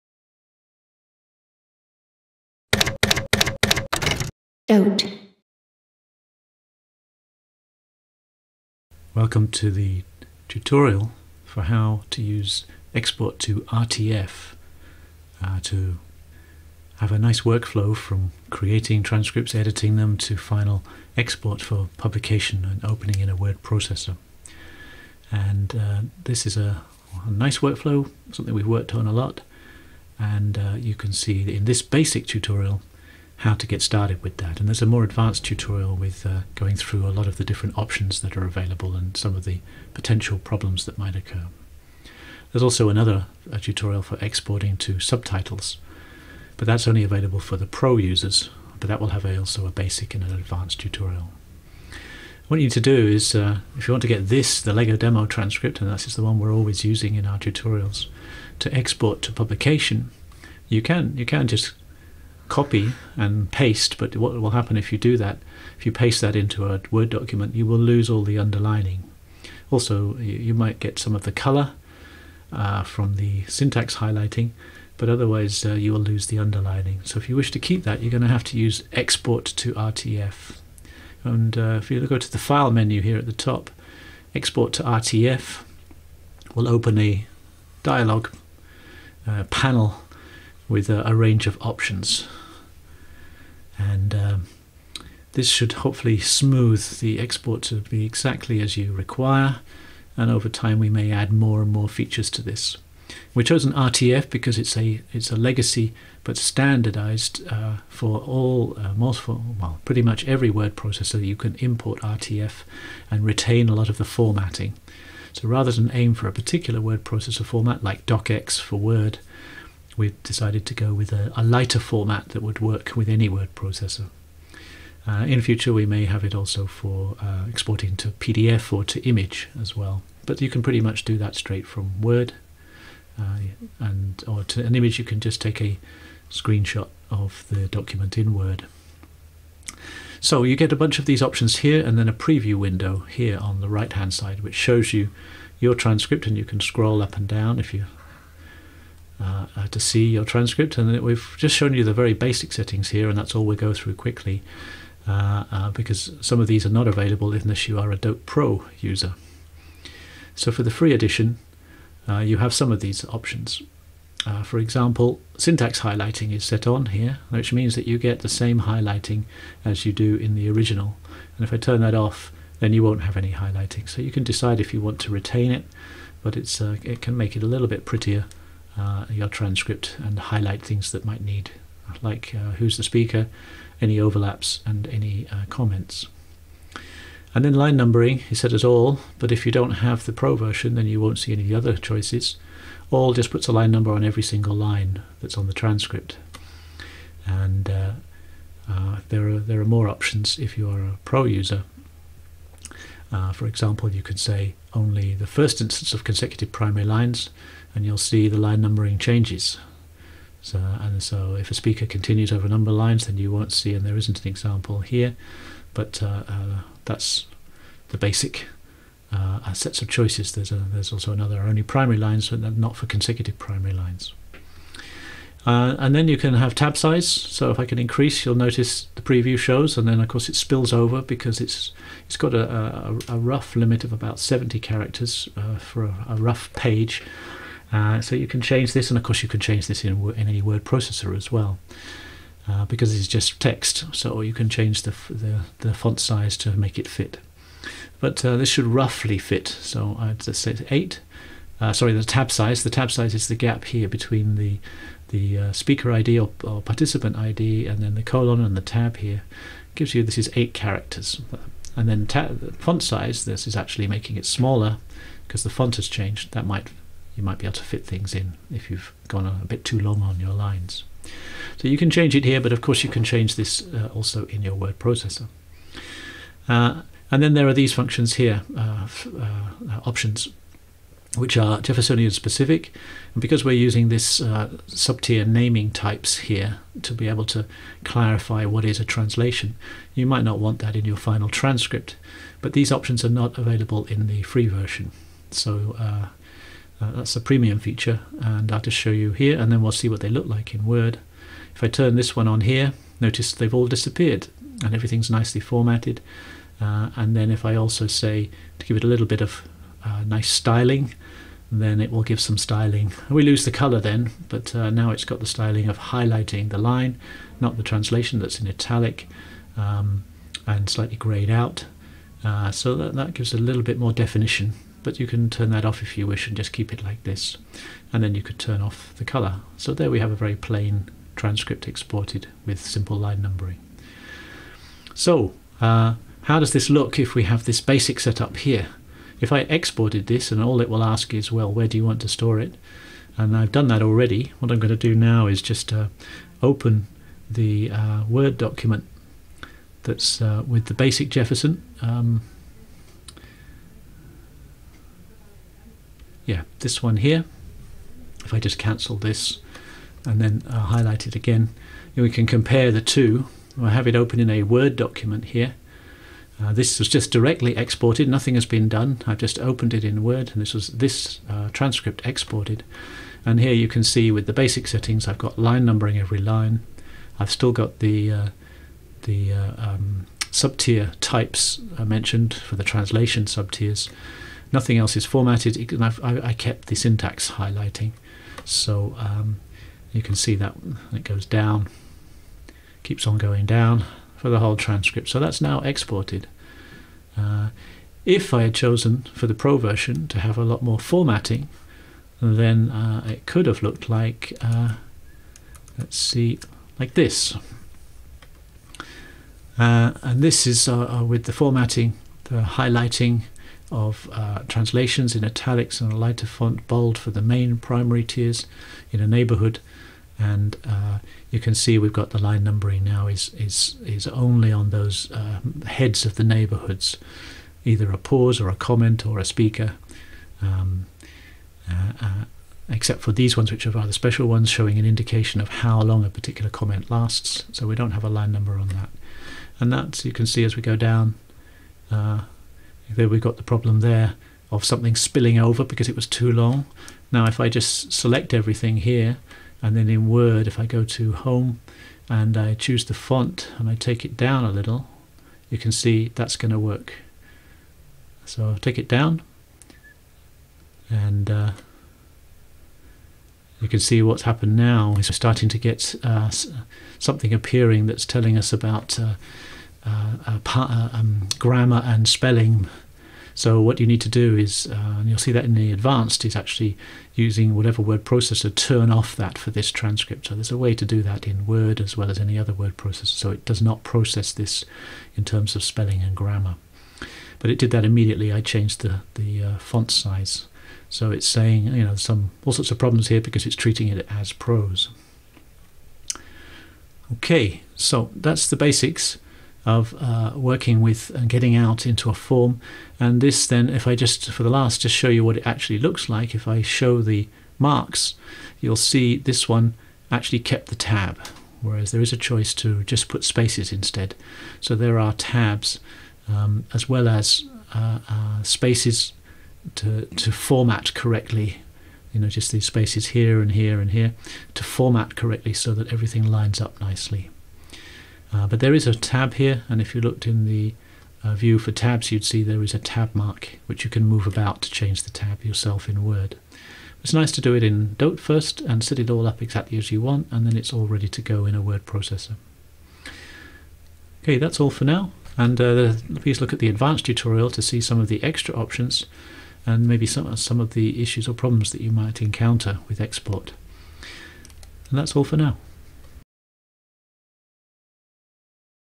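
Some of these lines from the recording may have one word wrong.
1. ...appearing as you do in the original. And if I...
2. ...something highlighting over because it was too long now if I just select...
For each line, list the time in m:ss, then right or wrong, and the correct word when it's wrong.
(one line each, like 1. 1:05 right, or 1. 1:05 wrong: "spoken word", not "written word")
1. 2:48 wrong: "highlighting", not "appearing"
2. 7:24 wrong: "spilling", not "highlighting".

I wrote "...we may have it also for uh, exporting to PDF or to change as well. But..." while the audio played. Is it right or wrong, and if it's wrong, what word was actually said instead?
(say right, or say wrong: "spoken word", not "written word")
wrong: "image", not "change".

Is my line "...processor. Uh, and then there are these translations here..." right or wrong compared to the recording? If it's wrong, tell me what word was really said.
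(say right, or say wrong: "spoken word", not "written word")
wrong: "functions", not "translations".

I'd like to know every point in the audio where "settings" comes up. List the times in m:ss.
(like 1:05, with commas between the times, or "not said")
2:32, 6:14.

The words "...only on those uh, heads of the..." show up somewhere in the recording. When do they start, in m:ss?
7:04.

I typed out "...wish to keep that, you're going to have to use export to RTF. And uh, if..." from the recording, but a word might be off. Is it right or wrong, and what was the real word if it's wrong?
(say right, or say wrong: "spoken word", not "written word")
right.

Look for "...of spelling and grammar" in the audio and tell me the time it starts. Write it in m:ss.
8:05.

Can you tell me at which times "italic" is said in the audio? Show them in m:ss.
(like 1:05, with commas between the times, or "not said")
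5:18, 6:55.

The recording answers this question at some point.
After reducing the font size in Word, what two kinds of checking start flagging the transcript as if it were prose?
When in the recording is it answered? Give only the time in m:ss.
7:51.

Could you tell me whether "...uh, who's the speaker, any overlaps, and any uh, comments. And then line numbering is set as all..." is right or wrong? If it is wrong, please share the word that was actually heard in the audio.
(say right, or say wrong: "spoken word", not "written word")
right.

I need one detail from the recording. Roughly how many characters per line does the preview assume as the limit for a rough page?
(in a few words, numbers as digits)
70.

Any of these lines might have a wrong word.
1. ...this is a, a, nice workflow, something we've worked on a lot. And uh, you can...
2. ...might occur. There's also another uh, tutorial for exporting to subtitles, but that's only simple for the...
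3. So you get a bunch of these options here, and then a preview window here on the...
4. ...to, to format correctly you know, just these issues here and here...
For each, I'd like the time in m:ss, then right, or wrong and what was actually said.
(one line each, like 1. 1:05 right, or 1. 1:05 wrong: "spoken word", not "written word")
1. 0:26 right
2. 0:40 wrong: "available", not "simple"
3. 2:20 right
4. 8:39 wrong: "spaces", not "issues".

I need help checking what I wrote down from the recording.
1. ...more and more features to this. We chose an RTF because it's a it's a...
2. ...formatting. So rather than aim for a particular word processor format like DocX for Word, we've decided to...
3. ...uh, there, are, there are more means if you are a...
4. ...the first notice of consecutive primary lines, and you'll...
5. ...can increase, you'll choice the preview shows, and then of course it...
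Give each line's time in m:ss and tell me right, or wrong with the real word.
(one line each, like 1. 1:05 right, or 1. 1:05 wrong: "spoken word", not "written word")
1. 1:41 right
2. 1:54 right
3. 3:18 wrong: "options", not "means"
4. 3:25 wrong: "instance", not "notice"
5. 3:47 wrong: "notice", not "choice".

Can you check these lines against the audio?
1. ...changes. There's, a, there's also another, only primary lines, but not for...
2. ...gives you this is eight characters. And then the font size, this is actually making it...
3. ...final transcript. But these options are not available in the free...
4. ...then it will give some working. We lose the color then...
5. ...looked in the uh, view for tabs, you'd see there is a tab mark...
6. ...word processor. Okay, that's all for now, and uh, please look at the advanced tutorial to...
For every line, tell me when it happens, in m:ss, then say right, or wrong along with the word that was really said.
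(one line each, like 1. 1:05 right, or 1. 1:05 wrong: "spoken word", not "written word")
1. 3:39 wrong: "choices", not "changes"
2. 4:19 right
3. 4:50 right
4. 5:11 wrong: "styling", not "working"
5. 8:50 right
6. 9:01 right.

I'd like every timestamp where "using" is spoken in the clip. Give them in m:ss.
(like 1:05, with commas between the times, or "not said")
0:56, 4:43, 7:57.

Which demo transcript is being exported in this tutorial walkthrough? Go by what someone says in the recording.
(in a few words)
LEGO demo.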